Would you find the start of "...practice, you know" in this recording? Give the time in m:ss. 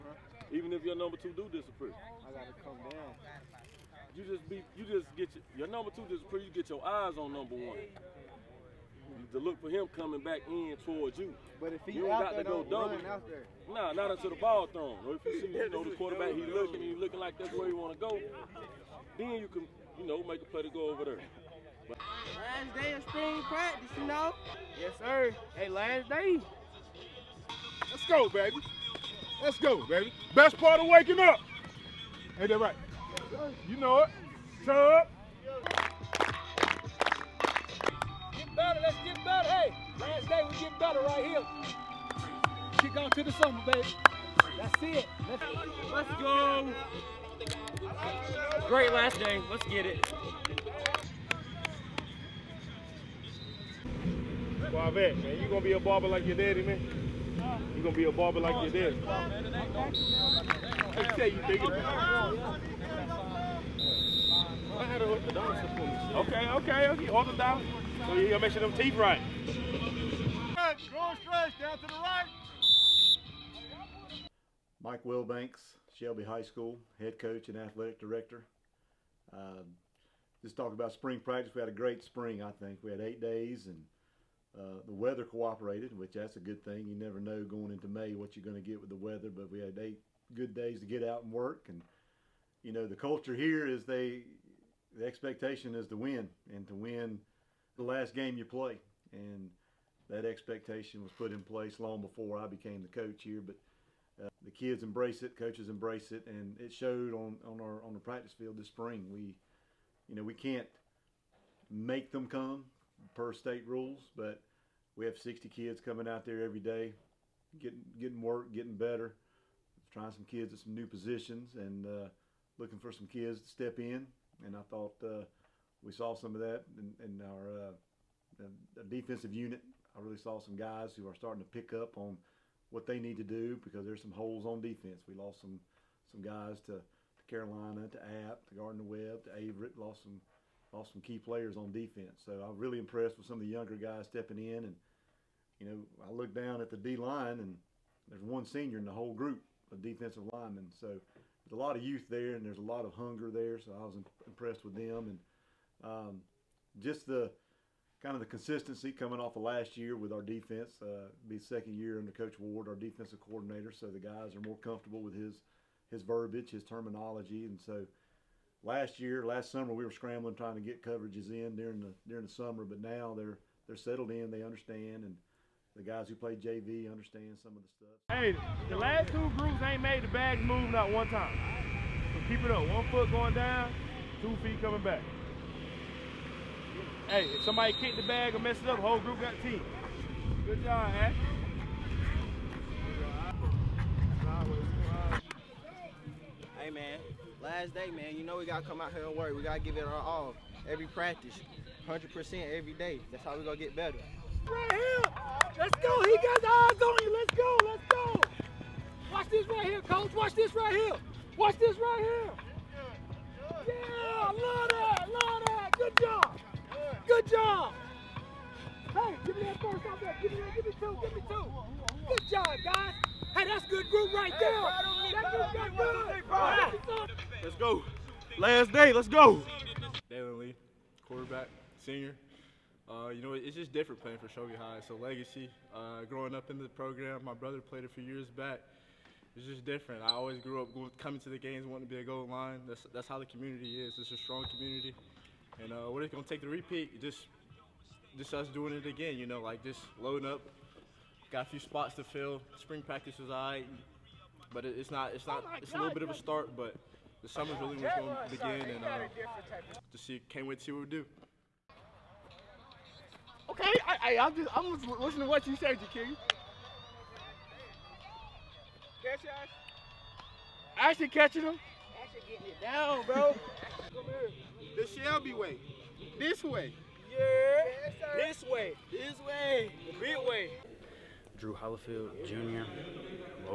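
0:23.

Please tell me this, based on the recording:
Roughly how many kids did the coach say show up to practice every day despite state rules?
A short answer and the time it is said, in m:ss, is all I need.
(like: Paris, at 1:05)
60, at 1:55.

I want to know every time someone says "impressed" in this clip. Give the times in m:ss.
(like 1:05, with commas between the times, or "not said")
2:22, 2:34.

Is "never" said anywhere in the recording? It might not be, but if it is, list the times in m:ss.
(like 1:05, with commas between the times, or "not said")
1:26.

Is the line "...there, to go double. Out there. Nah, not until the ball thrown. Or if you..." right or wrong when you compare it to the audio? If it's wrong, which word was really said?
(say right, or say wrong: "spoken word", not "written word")
right.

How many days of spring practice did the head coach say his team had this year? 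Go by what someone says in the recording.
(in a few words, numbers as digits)
8.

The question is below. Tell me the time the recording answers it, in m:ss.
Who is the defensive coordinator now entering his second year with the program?
2:42.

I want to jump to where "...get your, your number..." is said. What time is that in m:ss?
0:05.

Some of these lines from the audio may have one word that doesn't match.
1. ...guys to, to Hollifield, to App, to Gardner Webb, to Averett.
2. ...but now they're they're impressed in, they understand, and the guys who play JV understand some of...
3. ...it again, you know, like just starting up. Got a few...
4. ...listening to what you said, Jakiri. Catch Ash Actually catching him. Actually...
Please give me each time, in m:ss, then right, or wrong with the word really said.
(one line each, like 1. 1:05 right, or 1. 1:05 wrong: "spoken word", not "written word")
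1. 2:16 wrong: "Carolina", not "Hollifield"
2. 2:52 wrong: "settled", not "impressed"
3. 4:08 wrong: "loading", not "starting"
4. 4:25 right.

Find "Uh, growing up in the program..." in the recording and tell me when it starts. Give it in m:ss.
3:55.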